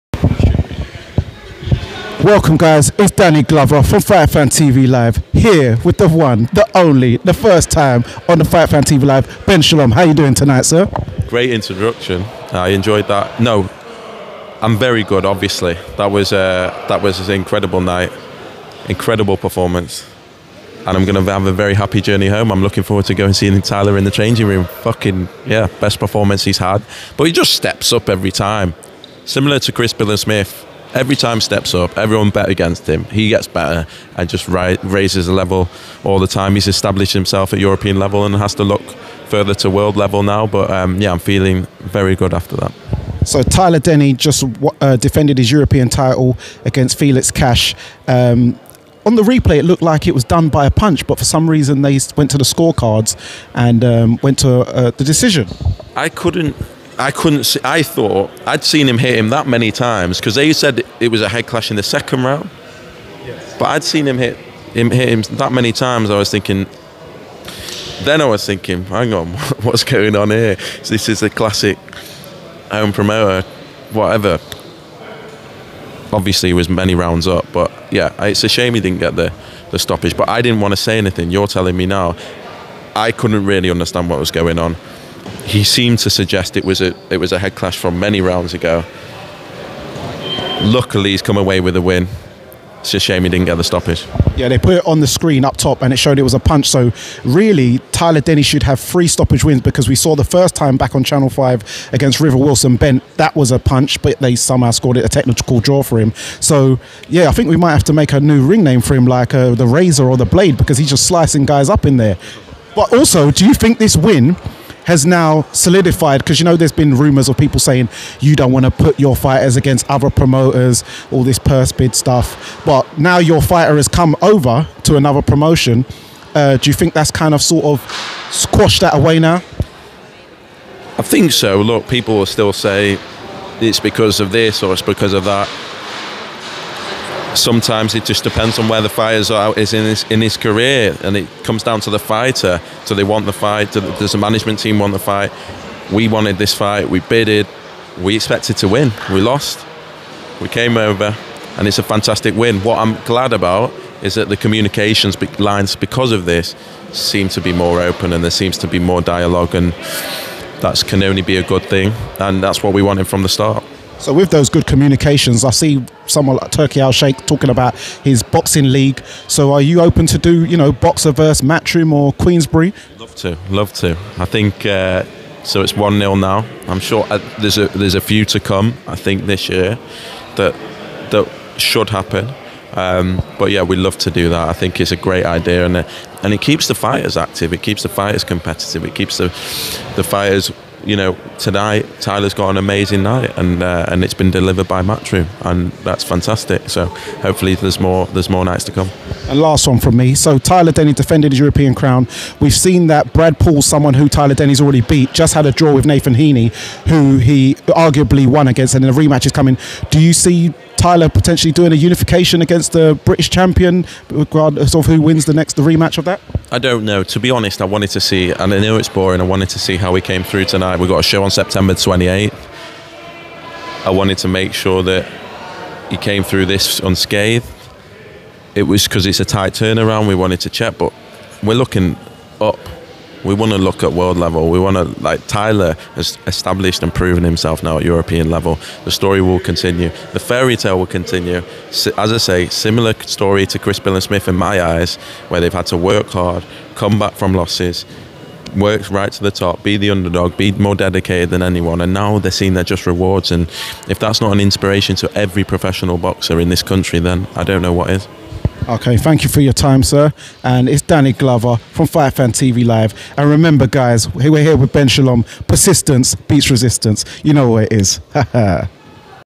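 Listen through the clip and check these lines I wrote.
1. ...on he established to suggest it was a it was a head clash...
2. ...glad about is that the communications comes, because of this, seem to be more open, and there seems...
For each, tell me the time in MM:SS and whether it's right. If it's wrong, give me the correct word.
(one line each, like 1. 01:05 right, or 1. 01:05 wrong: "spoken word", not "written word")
1. 01:24 wrong: "seemed", not "established"
2. 02:33 wrong: "lines", not "comes".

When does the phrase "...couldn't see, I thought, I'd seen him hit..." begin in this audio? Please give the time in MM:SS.
00:57.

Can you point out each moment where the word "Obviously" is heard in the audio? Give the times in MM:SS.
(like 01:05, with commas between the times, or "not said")
00:15, 01:16.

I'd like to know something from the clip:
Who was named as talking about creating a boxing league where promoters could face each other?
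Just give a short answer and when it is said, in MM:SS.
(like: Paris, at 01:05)
Turki Alalshikh, at 02:46.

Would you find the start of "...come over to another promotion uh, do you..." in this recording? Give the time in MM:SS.
02:03.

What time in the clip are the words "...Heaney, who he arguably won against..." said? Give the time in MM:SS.
03:26.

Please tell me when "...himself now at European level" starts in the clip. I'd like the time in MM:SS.
03:57.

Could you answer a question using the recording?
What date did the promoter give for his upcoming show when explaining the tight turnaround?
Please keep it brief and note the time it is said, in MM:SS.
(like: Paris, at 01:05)
September 28th, at 03:41.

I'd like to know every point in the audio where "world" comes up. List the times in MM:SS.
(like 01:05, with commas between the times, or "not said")
00:39, 03:53.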